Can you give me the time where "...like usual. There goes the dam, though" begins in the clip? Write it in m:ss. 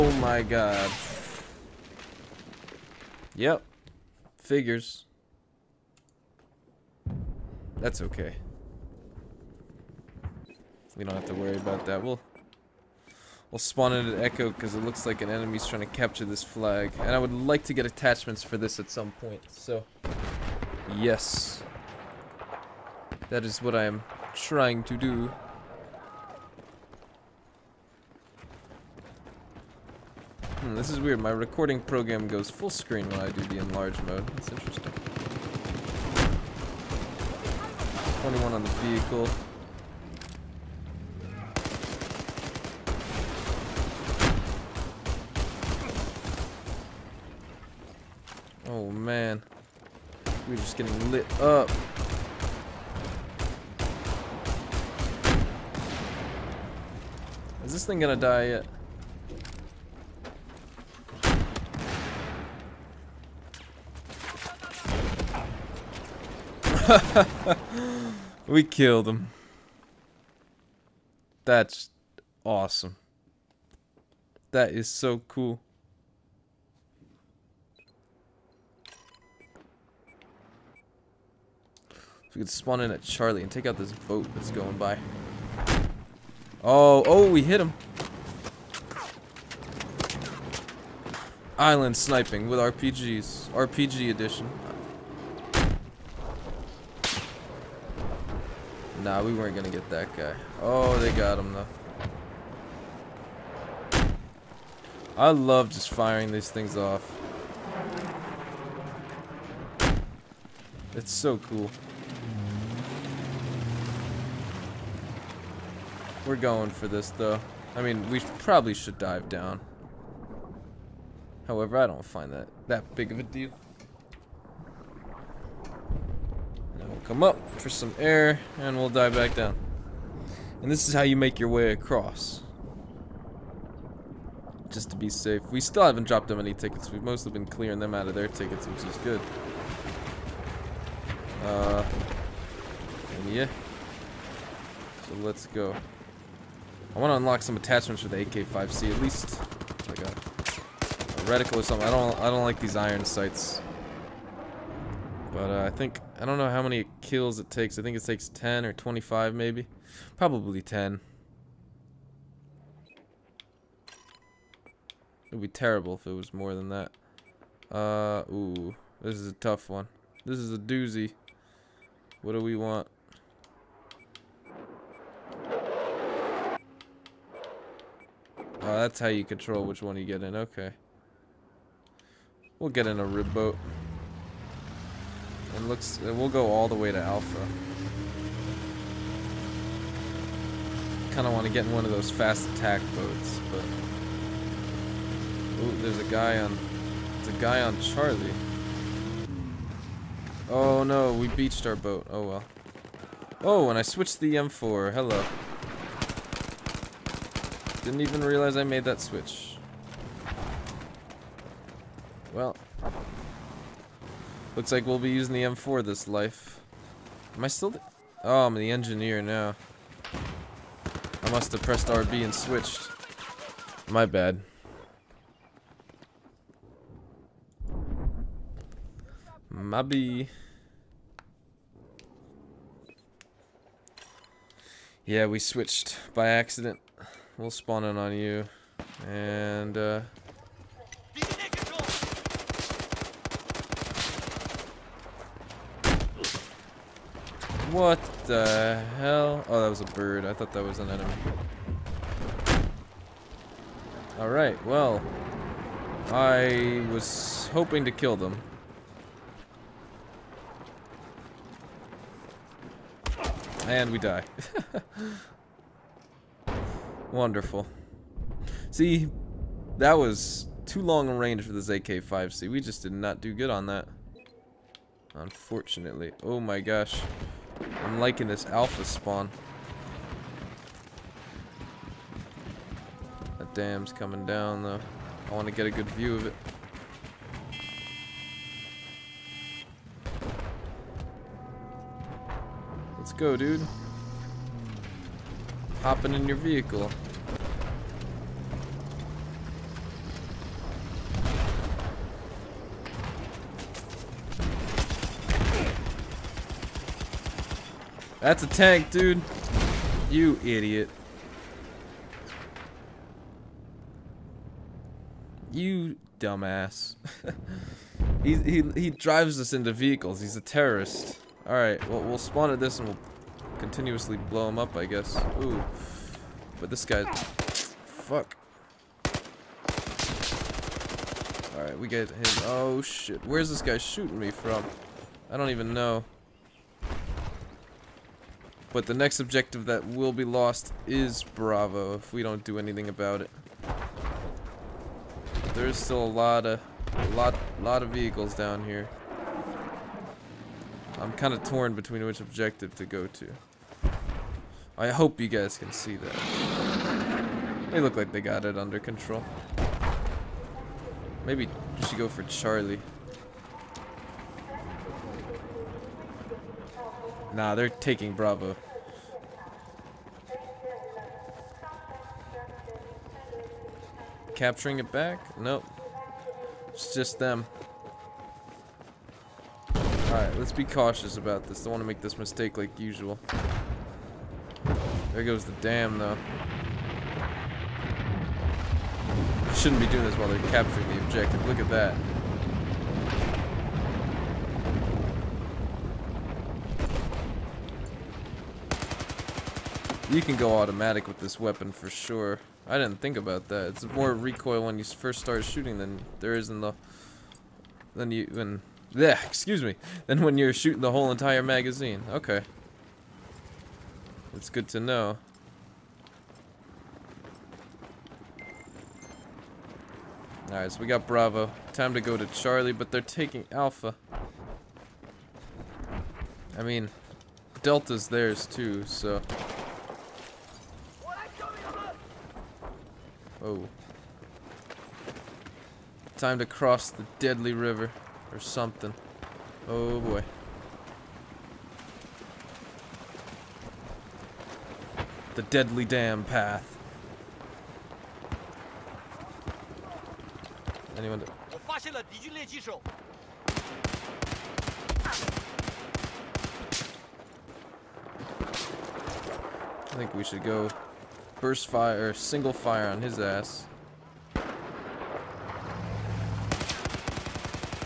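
6:22.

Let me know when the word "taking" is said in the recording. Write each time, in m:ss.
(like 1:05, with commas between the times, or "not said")
6:07, 7:03.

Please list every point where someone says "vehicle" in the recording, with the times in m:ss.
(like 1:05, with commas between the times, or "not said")
0:38, 4:56, 5:19, 5:47.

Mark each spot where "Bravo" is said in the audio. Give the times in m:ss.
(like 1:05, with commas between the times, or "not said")
5:41, 6:08, 7:01.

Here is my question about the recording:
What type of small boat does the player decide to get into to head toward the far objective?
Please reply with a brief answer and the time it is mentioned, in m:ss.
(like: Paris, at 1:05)
rib boat, at 3:03.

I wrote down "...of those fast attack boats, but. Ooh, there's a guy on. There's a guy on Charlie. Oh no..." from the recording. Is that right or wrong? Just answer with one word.
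right.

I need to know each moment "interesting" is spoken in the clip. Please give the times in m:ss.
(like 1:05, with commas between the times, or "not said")
0:34.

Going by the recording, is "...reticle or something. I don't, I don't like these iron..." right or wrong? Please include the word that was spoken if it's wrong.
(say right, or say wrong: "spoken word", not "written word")
right.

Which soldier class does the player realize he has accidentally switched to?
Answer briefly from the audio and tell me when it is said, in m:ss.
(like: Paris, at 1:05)
engineer, at 3:38.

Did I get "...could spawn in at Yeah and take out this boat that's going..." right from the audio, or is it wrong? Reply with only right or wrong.
wrong.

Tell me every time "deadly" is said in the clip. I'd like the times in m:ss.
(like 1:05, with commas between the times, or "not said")
7:17, 7:25.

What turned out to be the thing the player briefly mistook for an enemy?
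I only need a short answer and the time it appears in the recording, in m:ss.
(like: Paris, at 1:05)
a bird, at 4:09.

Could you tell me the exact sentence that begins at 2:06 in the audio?
Now we'll come up for some air, and we'll dive back down.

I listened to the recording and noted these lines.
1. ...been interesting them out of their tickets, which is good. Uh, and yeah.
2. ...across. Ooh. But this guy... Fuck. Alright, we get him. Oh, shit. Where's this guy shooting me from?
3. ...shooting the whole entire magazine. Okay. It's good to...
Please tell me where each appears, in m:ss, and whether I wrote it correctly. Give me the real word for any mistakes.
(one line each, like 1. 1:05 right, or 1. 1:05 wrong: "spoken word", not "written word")
1. 2:17 wrong: "clearing", not "interesting"
2. 5:24 wrong: "guess", not "across"
3. 6:50 right.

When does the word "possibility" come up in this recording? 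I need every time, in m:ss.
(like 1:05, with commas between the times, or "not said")
not said.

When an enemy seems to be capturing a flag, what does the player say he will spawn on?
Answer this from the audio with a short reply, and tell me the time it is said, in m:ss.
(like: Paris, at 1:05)
an echo, at 0:14.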